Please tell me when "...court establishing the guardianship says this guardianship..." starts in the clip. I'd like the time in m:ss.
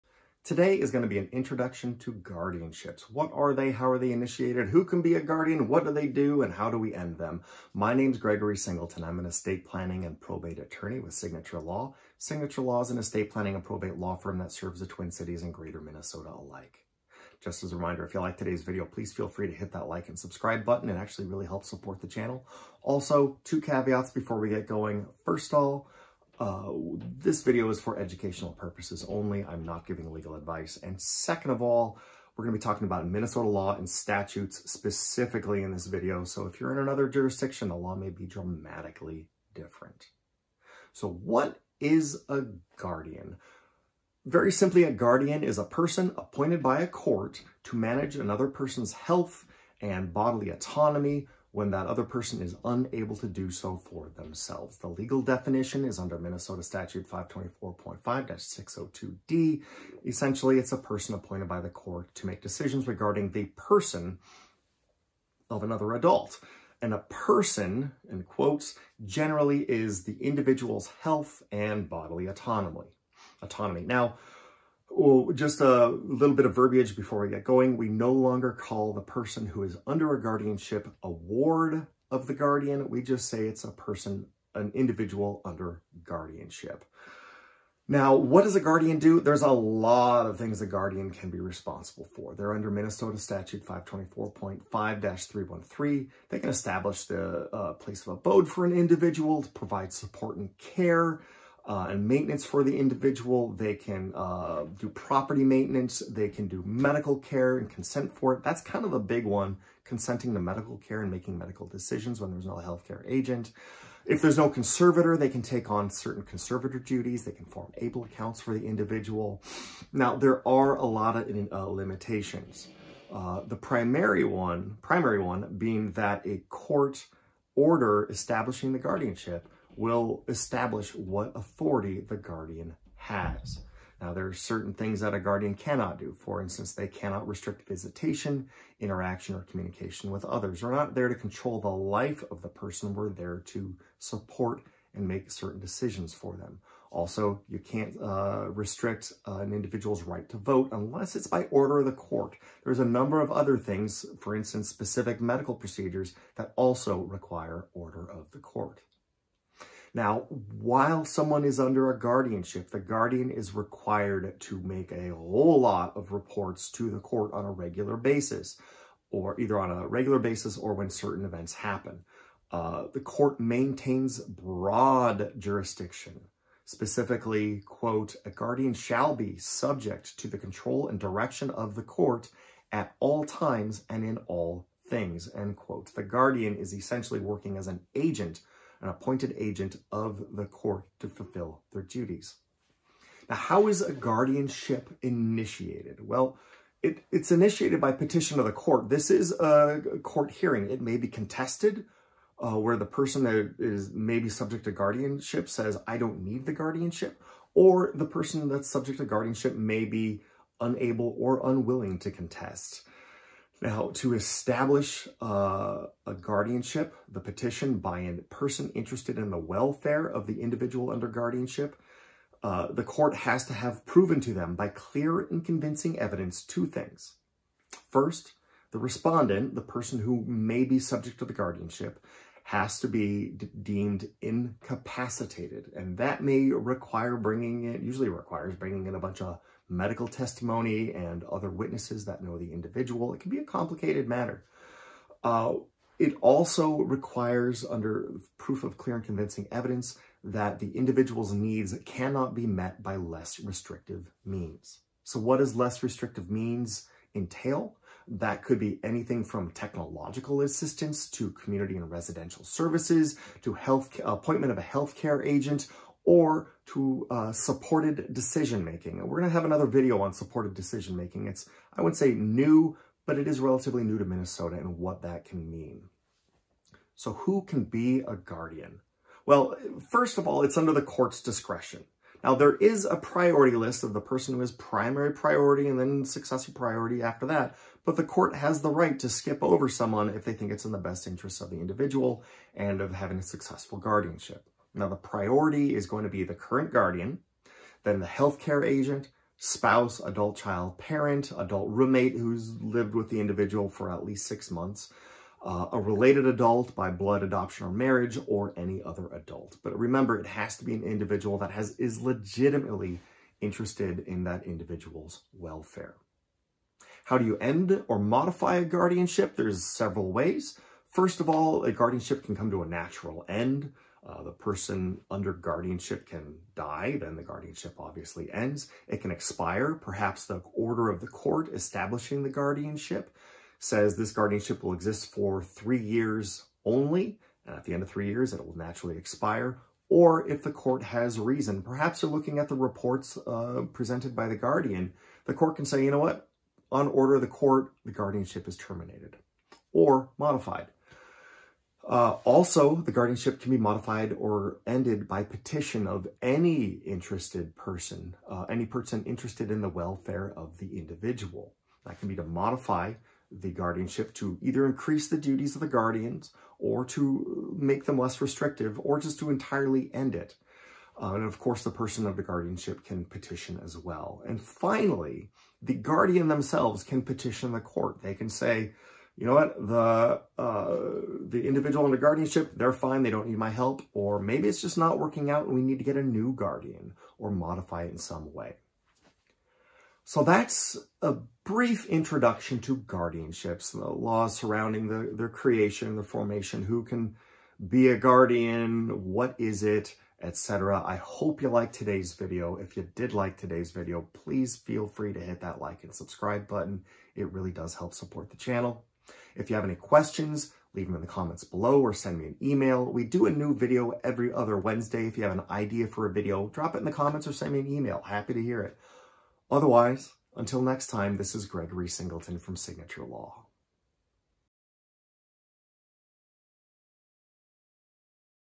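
5:31.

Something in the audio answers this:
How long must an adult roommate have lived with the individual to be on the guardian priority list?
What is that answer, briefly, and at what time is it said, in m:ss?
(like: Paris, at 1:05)
6 months, at 5:04.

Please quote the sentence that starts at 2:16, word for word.
For instance, they cannot restrict visitation, interaction, or communication with others.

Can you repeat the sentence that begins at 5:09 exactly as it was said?
But remember, it has to be an individual that has is legitimately interested in that individual's welfare.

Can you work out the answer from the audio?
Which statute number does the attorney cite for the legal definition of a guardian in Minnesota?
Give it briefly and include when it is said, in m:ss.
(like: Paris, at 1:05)
524.5-602D, at 0:57.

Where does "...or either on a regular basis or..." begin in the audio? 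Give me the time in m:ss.
2:49.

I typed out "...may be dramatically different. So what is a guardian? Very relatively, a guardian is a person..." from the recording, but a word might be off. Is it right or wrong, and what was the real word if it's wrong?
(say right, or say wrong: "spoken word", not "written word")
wrong: "simply", not "relatively".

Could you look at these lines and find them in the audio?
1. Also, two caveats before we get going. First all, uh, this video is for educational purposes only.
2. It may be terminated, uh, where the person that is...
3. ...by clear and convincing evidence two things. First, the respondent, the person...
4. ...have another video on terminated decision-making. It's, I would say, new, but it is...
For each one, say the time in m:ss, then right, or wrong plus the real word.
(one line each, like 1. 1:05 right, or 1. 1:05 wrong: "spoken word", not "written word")
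1. 0:22 right
2. 3:20 wrong: "contested", not "terminated"
3. 3:44 right
4. 4:29 wrong: "supported", not "terminated".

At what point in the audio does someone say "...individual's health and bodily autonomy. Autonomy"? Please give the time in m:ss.
1:10.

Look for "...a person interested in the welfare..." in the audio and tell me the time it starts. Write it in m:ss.
3:37.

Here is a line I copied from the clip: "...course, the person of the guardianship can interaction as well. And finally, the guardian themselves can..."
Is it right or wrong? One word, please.
wrong.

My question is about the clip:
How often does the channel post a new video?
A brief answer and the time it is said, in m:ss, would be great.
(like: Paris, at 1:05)
Every other Wednesday, at 6:54.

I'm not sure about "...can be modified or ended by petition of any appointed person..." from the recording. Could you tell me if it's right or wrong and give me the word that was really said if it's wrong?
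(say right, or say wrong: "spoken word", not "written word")
wrong: "interested", not "appointed".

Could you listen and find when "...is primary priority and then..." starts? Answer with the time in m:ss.
4:44.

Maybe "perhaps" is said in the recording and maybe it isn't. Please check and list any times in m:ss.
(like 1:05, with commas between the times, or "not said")
5:29, 5:41.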